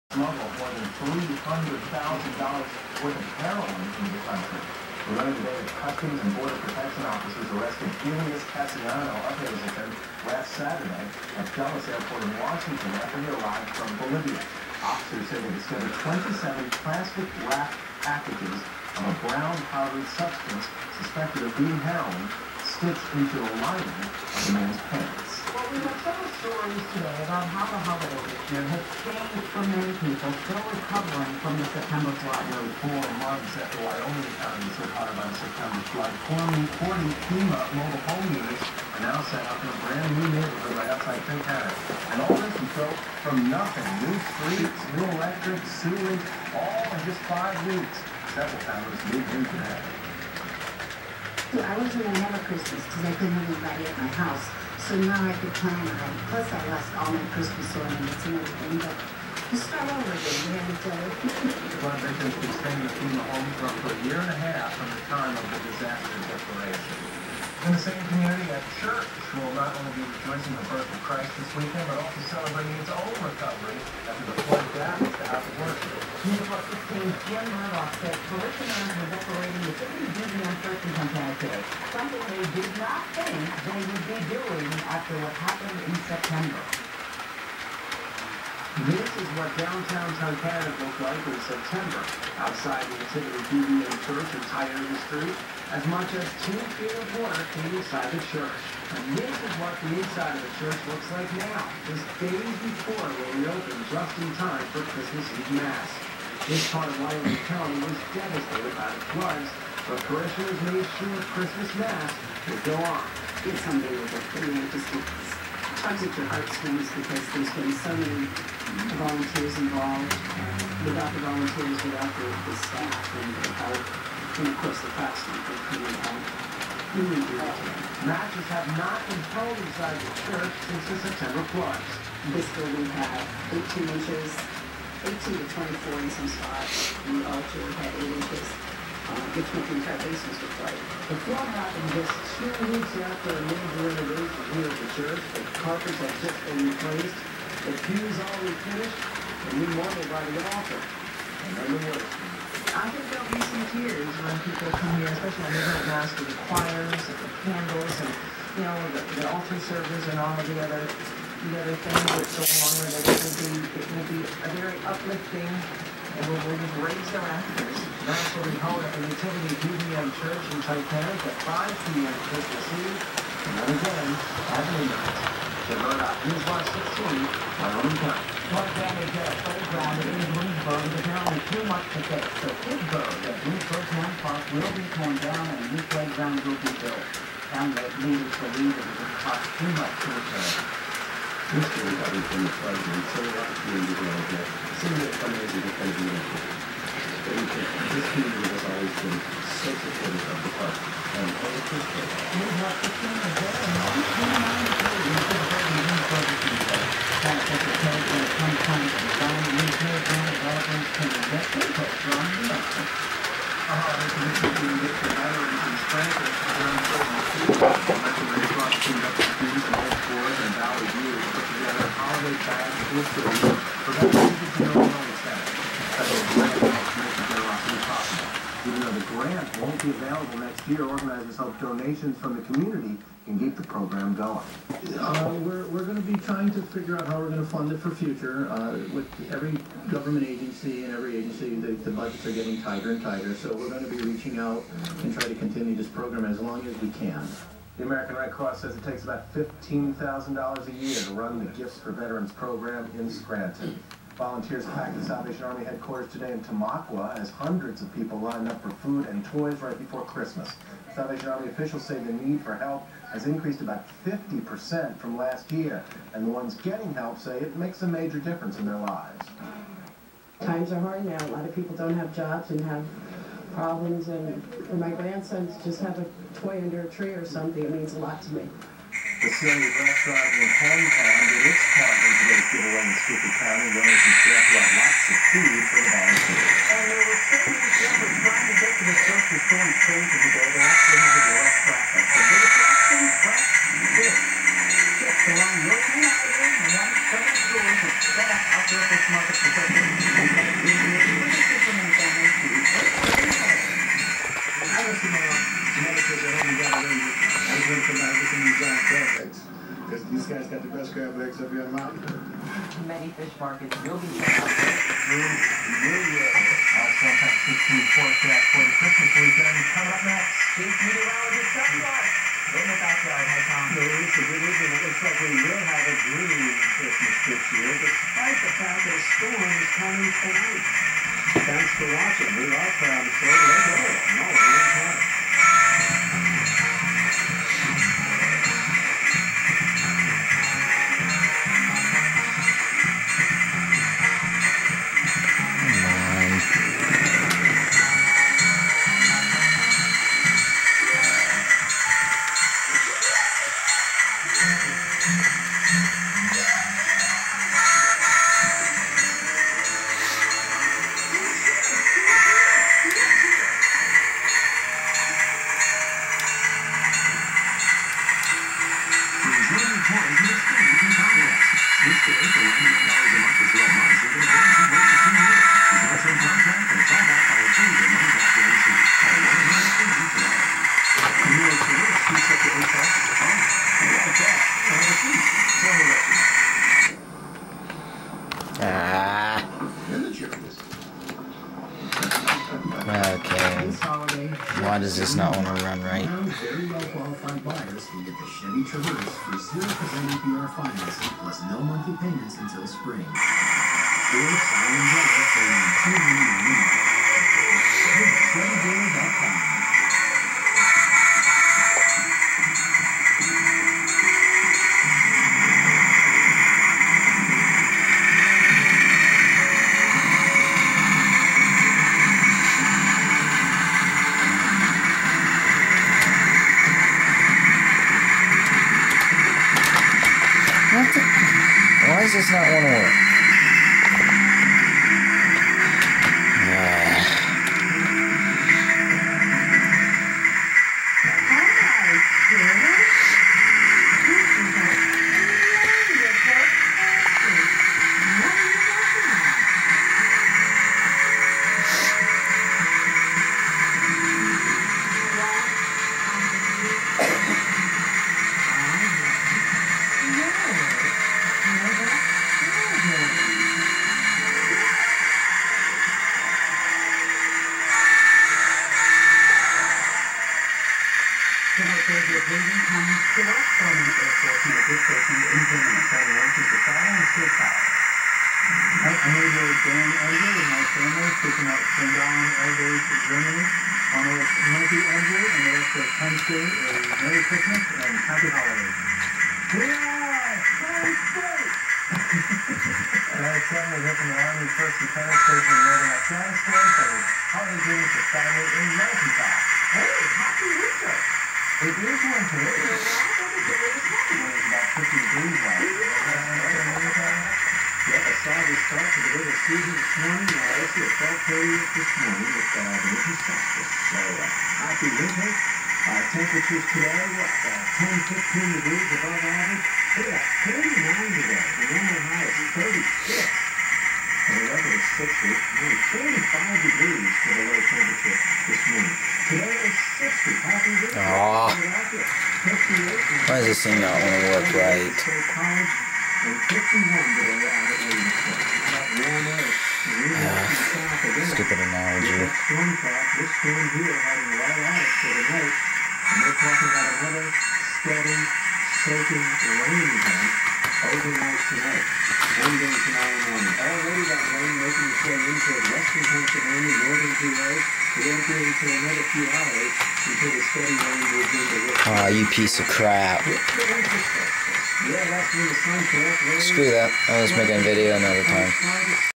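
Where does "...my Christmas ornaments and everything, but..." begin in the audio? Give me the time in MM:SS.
00:57.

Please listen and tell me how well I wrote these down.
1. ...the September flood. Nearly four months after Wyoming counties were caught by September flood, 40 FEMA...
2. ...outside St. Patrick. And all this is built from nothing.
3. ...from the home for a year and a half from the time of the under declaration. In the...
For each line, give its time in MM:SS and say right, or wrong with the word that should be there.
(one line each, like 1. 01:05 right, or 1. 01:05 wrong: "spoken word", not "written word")
1. 00:31 right
2. 00:40 right
3. 01:02 wrong: "disaster", not "under".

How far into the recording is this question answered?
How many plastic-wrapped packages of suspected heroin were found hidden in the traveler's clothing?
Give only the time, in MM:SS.
00:16.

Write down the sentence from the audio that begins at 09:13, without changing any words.
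Already that rain making its way into western Pennsylvania, northern PA.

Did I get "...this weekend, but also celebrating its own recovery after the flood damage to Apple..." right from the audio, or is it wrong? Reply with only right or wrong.
right.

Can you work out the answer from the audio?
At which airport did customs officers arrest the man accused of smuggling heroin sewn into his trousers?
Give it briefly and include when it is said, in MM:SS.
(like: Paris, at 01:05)
Dulles Airport, at 00:11.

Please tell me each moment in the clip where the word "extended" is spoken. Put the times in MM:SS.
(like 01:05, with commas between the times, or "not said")
01:02.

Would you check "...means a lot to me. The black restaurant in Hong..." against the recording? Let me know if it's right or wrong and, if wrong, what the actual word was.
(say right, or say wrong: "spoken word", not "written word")
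right.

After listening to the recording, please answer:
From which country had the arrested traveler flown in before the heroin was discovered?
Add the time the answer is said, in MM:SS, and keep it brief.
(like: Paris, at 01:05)
Bolivia, at 00:14.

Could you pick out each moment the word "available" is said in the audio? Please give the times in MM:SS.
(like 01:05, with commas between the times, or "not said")
03:49.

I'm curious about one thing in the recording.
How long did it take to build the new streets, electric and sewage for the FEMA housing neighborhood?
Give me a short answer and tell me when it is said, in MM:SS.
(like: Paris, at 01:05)
five weeks, at 00:47.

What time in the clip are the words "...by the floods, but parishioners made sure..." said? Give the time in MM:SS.
01:48.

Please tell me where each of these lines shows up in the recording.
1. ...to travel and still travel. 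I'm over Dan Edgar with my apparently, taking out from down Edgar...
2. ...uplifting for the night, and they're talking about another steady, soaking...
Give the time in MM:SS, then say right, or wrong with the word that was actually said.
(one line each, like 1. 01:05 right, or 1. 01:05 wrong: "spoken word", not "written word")
1. 07:56 wrong: "family", not "apparently"
2. 09:04 wrong: "heading", not "uplifting".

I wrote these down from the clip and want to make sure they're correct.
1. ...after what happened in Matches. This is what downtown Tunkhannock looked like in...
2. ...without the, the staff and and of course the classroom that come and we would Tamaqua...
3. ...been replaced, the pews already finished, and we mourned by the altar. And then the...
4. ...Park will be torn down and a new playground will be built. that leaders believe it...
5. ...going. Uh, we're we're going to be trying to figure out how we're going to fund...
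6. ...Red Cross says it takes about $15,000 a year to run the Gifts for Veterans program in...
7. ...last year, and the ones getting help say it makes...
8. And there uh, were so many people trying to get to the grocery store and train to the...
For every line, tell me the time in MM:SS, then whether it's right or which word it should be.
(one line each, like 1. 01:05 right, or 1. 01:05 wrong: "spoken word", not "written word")
1. 01:24 wrong: "September", not "Matches"
2. 02:01 wrong: "Matches", not "Tamaqua"
3. 02:26 right
4. 03:04 right
5. 03:54 right
6. 04:08 right
7. 04:25 right
8. 04:46 right.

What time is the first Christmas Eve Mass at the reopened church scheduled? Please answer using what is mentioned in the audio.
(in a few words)
5 p.m.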